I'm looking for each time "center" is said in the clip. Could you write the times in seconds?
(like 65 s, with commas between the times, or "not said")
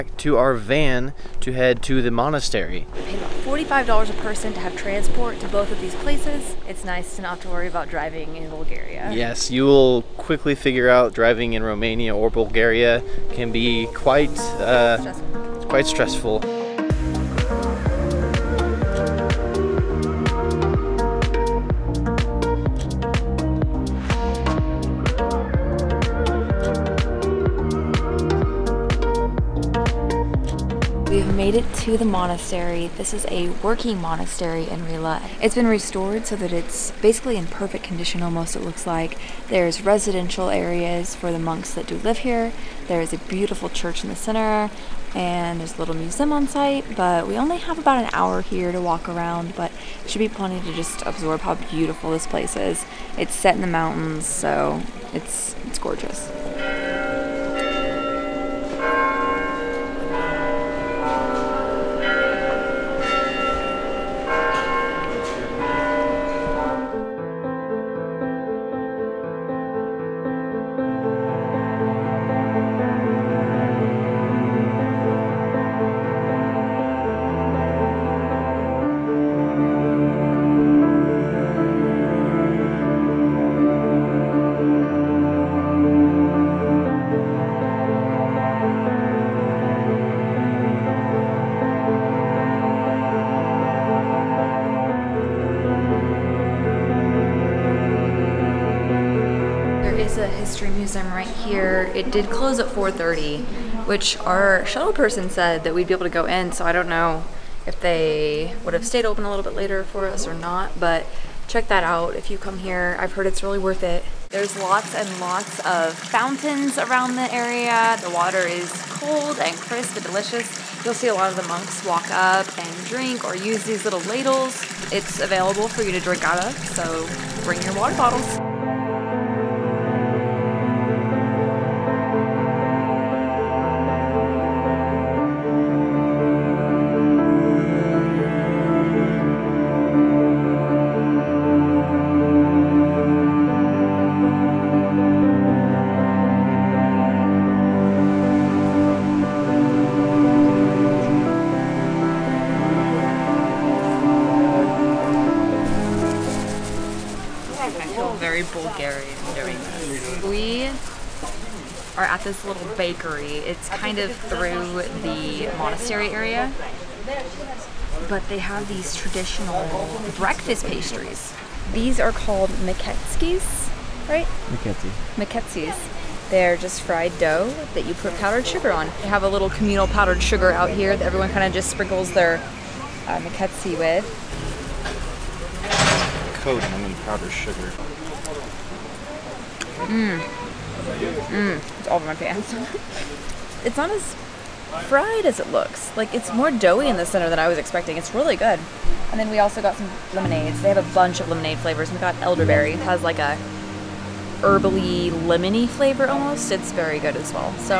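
44 s, 197 s.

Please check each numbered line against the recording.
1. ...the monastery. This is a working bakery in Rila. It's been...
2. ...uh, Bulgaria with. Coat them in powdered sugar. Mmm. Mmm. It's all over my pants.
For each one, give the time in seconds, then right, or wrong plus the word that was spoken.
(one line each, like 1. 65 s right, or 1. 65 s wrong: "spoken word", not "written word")
1. 31 s wrong: "monastery", not "bakery"
2. 183 s wrong: "Miketsi", not "Bulgaria".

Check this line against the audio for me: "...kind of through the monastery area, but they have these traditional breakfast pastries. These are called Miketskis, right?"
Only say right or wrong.
right.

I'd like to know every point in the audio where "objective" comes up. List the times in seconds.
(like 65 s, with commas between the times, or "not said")
not said.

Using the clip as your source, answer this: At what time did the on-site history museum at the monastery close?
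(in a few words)
4:30.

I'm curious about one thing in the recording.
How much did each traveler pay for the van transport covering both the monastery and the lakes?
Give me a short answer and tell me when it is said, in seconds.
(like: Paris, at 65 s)
$45, at 3 s.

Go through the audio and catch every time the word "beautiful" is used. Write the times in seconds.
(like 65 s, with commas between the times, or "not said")
43 s, 51 s.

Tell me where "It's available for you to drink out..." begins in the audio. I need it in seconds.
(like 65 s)
124 s.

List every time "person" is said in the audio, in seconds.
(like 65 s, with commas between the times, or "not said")
4 s, 104 s.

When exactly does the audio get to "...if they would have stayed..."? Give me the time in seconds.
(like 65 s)
107 s.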